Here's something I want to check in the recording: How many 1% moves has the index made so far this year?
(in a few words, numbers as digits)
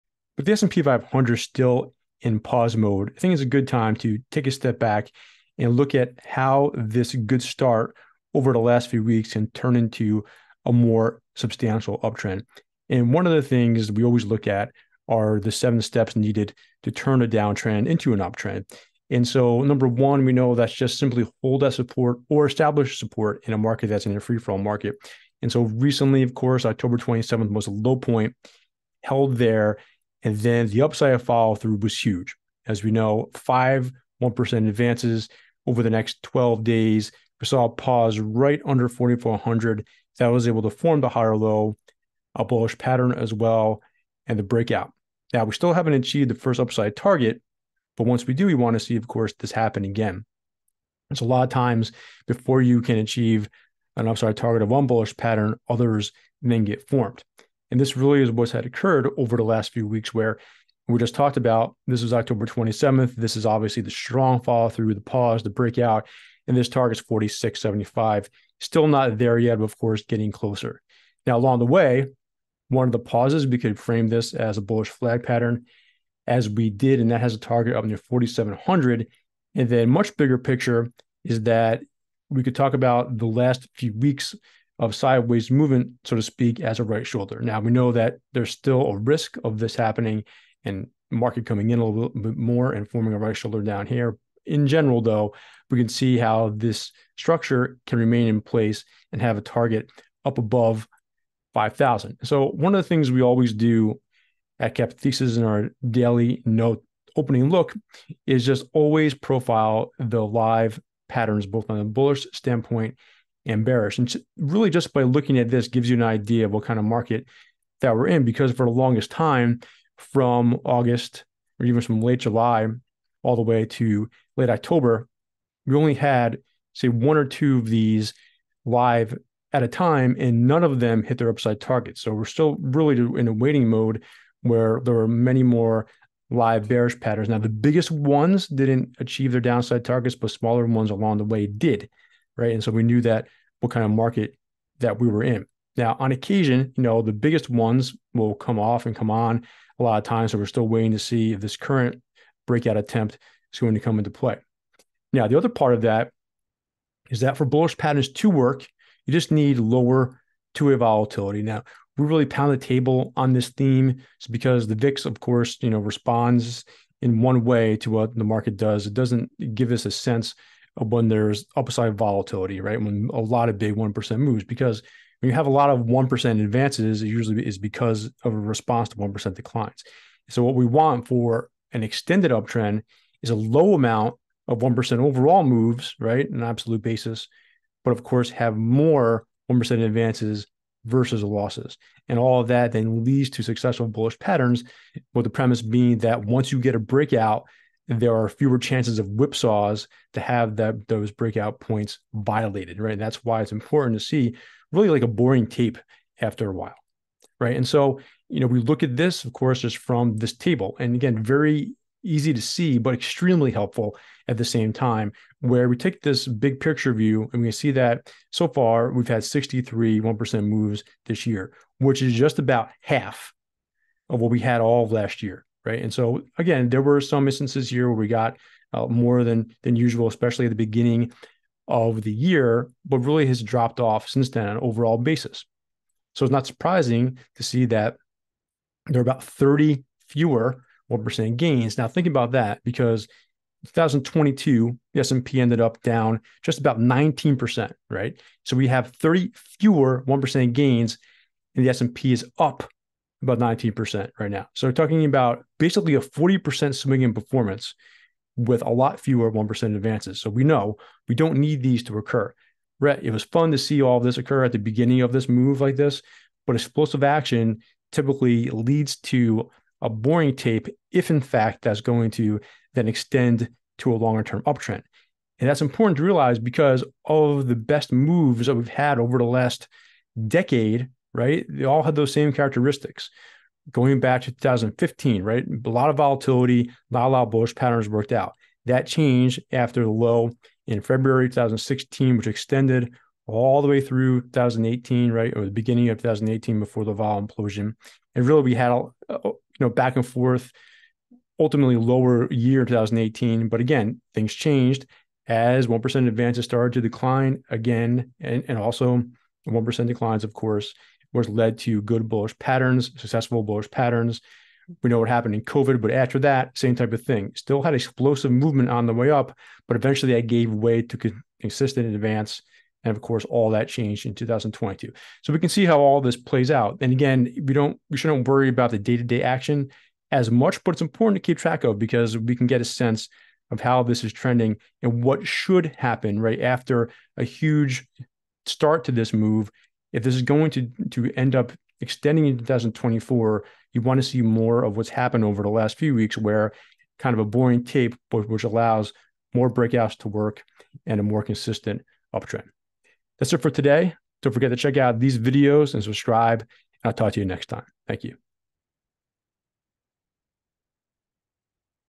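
63.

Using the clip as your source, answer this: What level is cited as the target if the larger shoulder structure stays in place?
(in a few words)
above 5,000.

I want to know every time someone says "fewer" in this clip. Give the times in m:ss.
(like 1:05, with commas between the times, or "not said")
3:18, 4:00, 4:09, 4:18.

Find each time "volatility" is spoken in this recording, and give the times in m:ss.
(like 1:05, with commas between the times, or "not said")
2:40, 2:51, 4:45.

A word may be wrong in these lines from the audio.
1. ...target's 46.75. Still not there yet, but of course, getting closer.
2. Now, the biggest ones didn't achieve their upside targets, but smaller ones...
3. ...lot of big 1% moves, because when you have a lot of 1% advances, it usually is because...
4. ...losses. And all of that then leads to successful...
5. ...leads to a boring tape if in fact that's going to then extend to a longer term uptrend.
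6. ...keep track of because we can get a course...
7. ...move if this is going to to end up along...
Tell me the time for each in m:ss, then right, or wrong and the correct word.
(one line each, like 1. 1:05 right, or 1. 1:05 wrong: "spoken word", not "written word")
1. 1:06 right
2. 2:17 wrong: "downside", not "upside"
3. 2:53 right
4. 3:11 right
5. 4:28 right
6. 5:31 wrong: "sense", not "course"
7. 5:39 wrong: "extending", not "along".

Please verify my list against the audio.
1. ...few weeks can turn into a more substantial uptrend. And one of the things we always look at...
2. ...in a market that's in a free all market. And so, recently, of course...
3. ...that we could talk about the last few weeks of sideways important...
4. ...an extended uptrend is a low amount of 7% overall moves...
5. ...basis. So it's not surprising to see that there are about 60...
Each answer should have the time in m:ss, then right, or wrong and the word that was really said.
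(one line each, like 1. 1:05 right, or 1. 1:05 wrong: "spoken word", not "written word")
1. 0:08 right
2. 0:23 right
3. 1:21 wrong: "movement", not "important"
4. 3:01 wrong: "1", not "7"
5. 3:54 wrong: "30", not "60".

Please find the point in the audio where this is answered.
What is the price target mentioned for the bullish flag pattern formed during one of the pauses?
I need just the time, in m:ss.
1:17.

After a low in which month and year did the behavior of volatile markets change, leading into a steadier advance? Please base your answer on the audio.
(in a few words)
February 2016.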